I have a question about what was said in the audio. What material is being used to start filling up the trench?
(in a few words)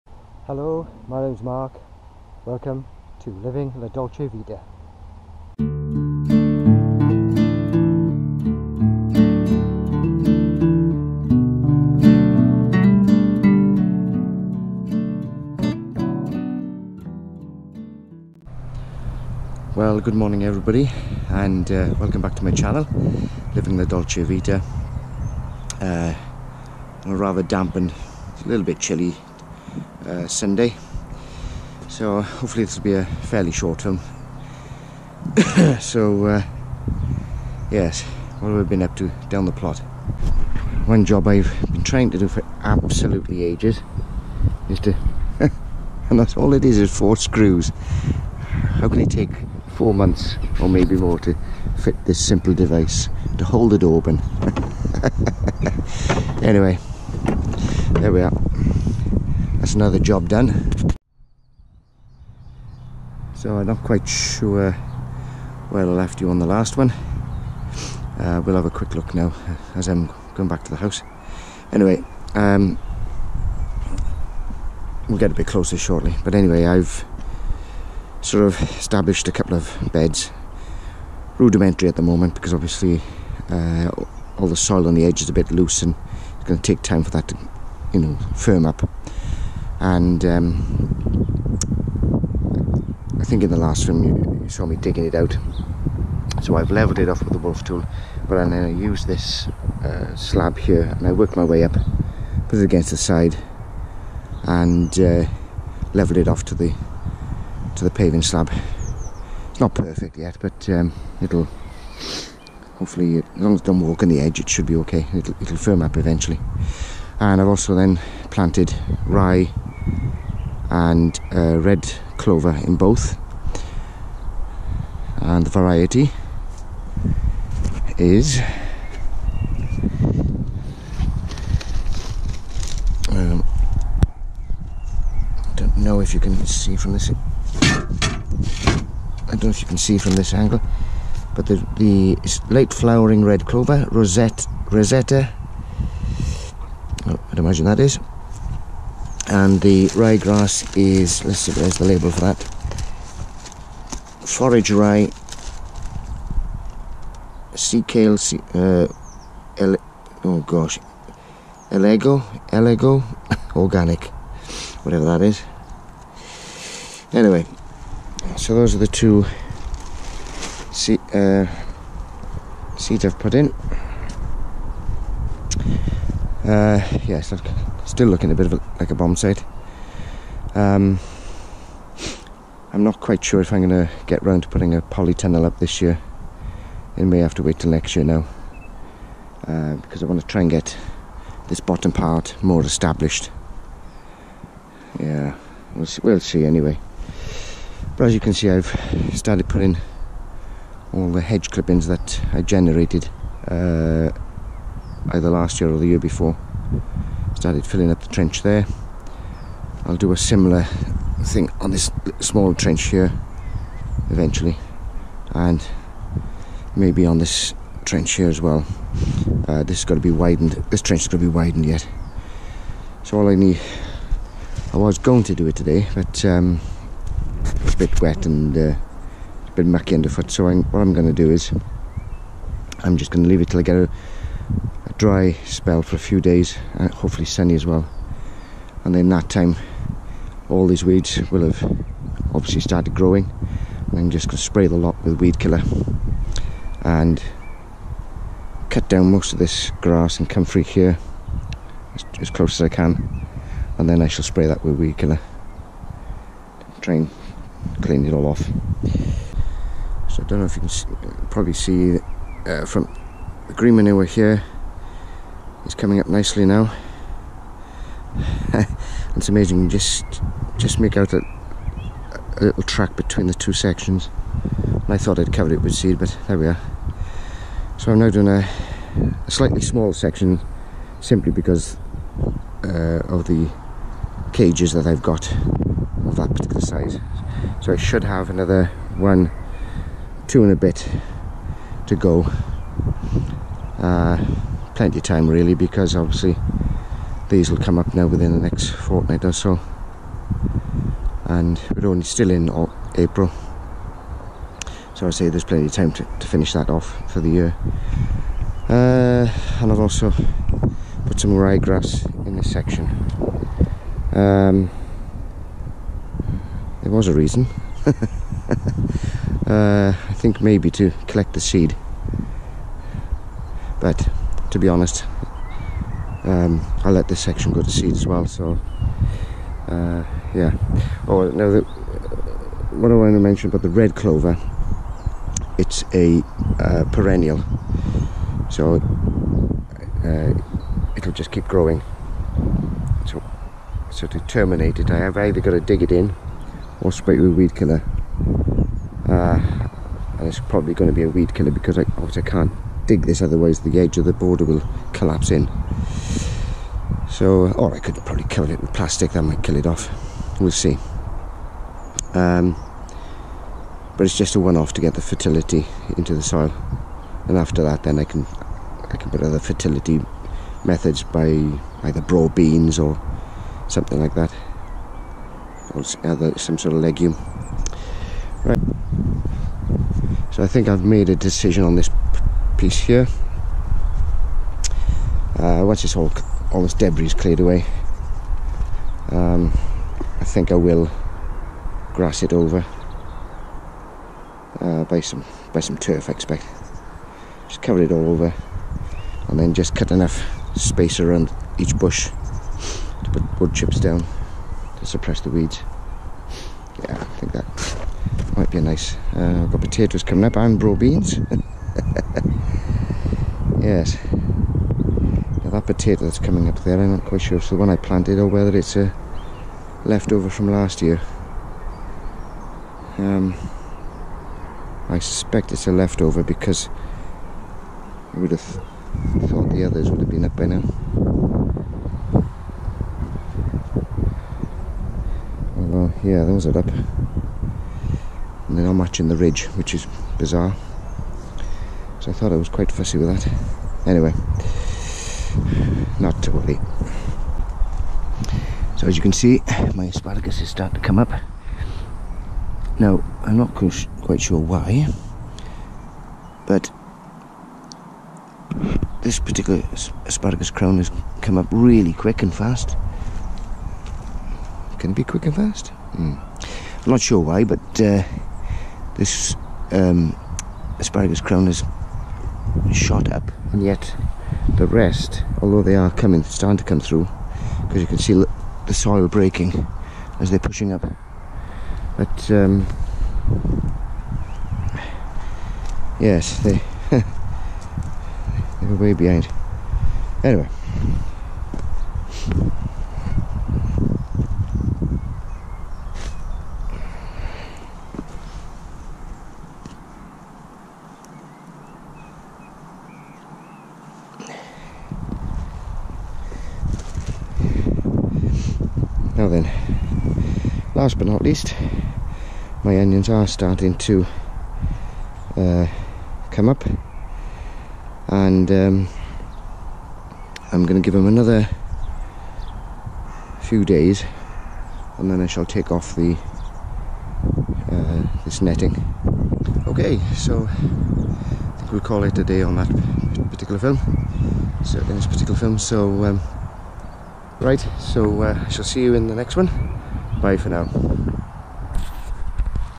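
hedge clippings.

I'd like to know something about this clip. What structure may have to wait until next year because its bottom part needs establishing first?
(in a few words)
polytunnel.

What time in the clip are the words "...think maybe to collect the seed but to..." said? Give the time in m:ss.
5:20.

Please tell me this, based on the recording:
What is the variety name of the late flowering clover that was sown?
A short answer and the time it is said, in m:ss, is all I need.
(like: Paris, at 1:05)
Rosetta, at 2:24.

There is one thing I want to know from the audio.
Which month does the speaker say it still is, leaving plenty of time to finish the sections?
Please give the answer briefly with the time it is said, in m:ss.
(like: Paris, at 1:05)
April, at 5:02.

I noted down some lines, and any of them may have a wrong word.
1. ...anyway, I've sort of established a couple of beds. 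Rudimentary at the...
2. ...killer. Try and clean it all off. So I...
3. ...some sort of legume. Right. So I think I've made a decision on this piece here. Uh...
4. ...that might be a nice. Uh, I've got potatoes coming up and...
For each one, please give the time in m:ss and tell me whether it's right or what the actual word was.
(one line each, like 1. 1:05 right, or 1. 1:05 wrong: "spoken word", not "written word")
1. 1:16 right
2. 4:14 right
3. 6:16 right
4. 6:47 right.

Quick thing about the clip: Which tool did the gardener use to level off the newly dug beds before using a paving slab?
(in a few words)
wolf tool.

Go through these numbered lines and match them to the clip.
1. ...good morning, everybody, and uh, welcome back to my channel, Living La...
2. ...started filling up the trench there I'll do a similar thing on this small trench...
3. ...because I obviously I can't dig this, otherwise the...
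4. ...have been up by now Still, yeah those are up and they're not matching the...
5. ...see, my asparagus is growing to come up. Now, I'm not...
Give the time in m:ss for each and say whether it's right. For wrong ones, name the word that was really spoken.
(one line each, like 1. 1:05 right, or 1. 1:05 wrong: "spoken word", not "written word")
1. 0:20 right
2. 3:27 right
3. 5:51 right
4. 7:09 wrong: "Well", not "Still"
5. 7:29 wrong: "starting", not "growing".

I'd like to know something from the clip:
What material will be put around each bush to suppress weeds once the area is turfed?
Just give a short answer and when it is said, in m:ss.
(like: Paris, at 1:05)
wood chips, at 6:43.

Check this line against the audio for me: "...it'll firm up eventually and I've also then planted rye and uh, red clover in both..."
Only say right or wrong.
right.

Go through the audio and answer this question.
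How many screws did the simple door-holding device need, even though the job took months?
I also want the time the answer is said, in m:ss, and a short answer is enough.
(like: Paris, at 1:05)
4, at 0:46.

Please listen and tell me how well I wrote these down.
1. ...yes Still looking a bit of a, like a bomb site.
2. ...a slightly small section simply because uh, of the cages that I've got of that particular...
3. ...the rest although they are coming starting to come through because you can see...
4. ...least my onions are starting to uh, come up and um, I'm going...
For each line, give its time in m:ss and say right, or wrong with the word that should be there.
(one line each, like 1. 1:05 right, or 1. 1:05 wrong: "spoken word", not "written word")
1. 2:57 right
2. 4:39 right
3. 7:54 right
4. 8:31 right.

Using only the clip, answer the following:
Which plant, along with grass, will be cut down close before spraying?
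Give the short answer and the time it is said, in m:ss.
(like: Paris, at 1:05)
comfrey, at 4:10.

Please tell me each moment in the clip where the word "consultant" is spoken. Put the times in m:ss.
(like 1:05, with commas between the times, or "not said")
not said.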